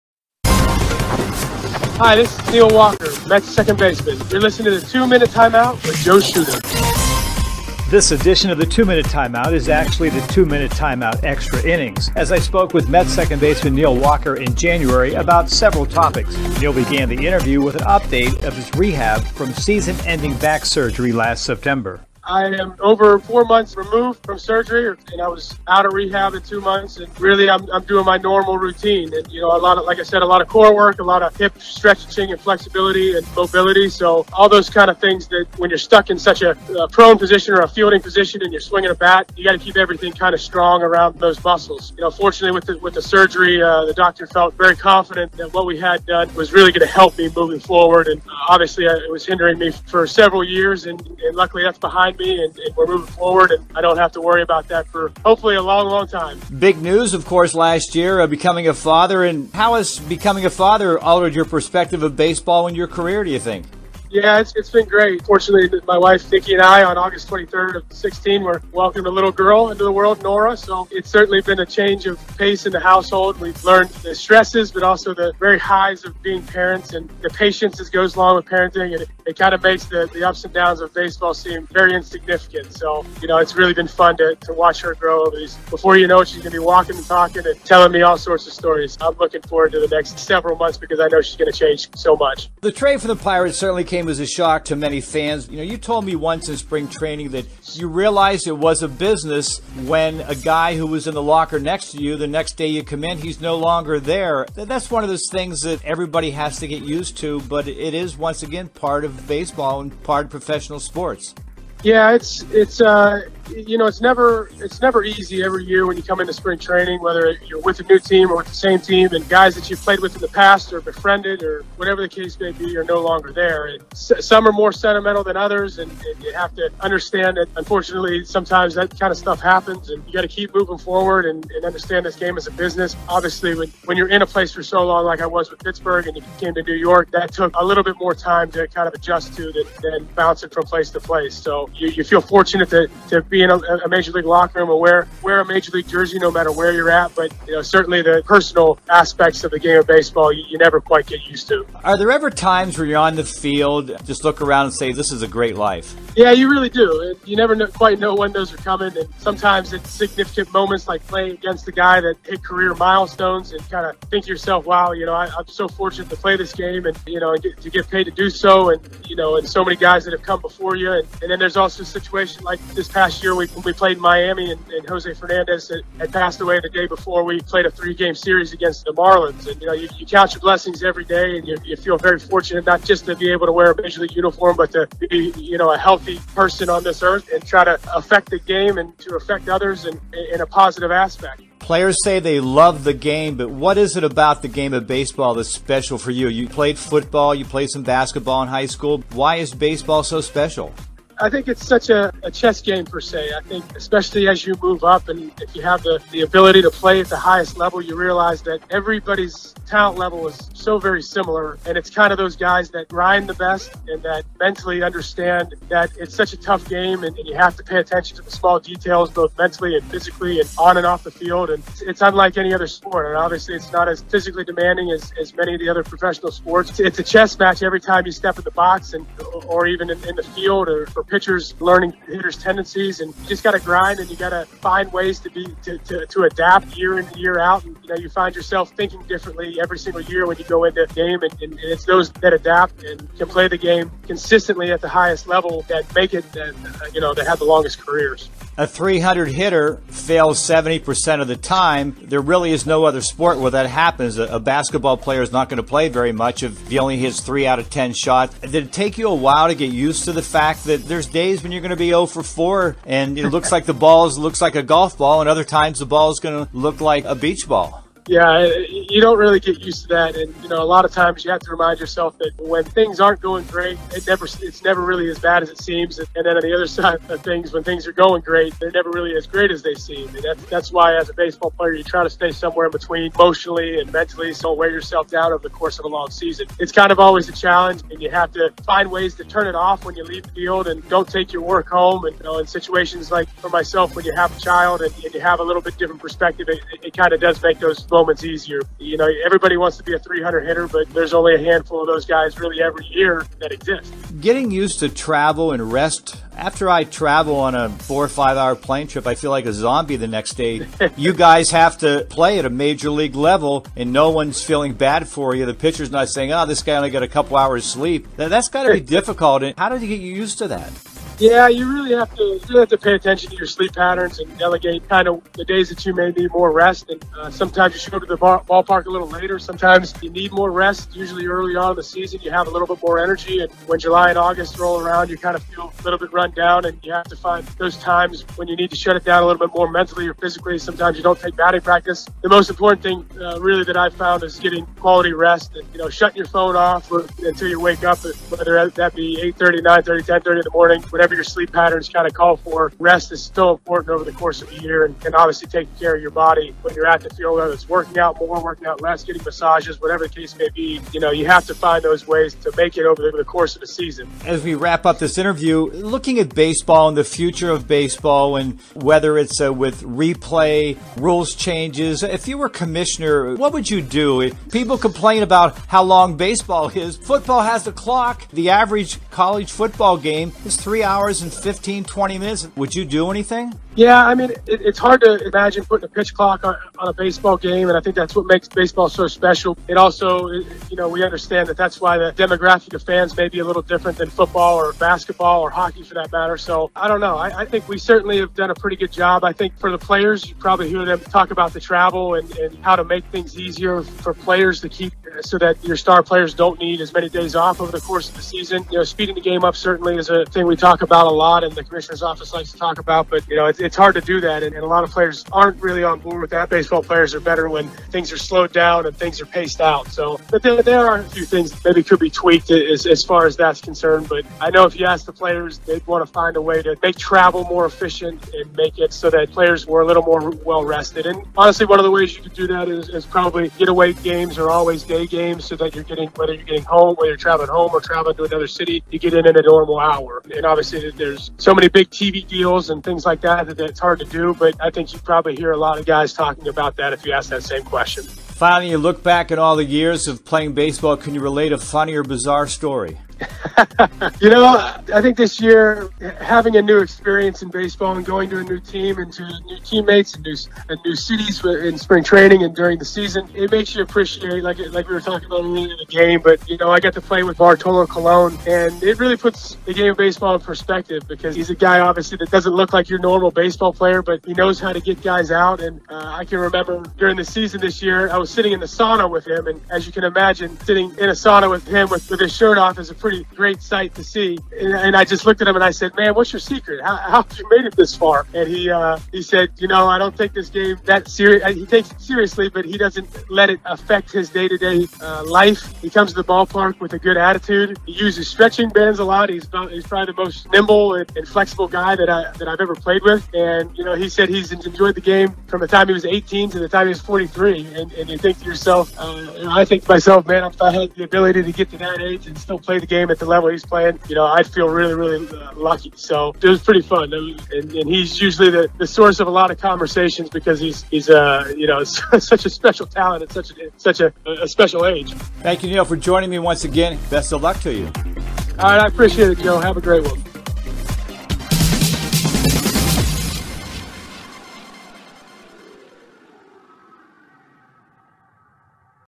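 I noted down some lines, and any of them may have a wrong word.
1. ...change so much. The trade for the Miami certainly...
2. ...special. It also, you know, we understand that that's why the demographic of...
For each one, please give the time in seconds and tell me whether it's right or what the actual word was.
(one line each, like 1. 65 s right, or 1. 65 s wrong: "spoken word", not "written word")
1. 91 s wrong: "Pirates", not "Miami"
2. 389 s right.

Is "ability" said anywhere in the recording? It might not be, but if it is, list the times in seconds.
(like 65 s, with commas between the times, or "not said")
206 s, 511 s.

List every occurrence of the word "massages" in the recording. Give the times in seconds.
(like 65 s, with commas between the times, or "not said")
359 s.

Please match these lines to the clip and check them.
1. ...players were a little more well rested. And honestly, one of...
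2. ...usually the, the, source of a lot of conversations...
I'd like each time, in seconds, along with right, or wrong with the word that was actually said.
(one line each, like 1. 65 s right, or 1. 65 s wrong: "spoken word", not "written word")
1. 429 s right
2. 518 s right.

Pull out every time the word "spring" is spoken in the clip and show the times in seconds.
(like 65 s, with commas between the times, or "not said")
96 s, 116 s, 461 s.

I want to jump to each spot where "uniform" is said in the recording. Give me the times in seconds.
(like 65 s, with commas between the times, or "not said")
184 s.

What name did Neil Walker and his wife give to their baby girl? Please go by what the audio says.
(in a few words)
Nora.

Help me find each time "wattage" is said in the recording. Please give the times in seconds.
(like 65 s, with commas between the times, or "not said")
not said.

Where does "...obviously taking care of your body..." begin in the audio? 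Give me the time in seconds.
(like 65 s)
355 s.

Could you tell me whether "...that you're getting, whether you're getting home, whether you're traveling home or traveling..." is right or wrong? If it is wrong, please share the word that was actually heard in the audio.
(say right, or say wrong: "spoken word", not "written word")
right.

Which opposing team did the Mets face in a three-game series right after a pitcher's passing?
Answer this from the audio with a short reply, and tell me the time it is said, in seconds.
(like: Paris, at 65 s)
Marlins, at 178 s.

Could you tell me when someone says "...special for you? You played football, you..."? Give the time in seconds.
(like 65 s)
195 s.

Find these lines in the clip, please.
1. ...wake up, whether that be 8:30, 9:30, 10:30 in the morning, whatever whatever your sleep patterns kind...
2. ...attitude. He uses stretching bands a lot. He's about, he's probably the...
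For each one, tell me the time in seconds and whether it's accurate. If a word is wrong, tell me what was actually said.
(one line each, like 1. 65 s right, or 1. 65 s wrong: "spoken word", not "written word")
1. 347 s right
2. 497 s right.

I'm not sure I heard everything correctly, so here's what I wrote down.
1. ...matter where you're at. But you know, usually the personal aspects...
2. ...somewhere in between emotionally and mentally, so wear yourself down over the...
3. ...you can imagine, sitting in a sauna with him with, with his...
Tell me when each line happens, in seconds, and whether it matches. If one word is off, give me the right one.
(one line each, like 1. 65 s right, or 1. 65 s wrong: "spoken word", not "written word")
1. 146 s wrong: "certainly", not "usually"
2. 282 s right
3. 479 s right.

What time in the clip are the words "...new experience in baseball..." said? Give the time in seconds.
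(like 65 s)
456 s.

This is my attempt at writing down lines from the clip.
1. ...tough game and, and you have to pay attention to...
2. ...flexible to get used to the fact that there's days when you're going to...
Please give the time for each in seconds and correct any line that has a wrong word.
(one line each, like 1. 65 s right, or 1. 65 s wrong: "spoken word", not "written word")
1. 216 s right
2. 259 s wrong: "while", not "flexible".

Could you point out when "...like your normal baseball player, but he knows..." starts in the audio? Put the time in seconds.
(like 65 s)
472 s.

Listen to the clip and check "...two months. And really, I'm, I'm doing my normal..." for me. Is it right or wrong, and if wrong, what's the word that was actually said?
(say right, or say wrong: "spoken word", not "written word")
right.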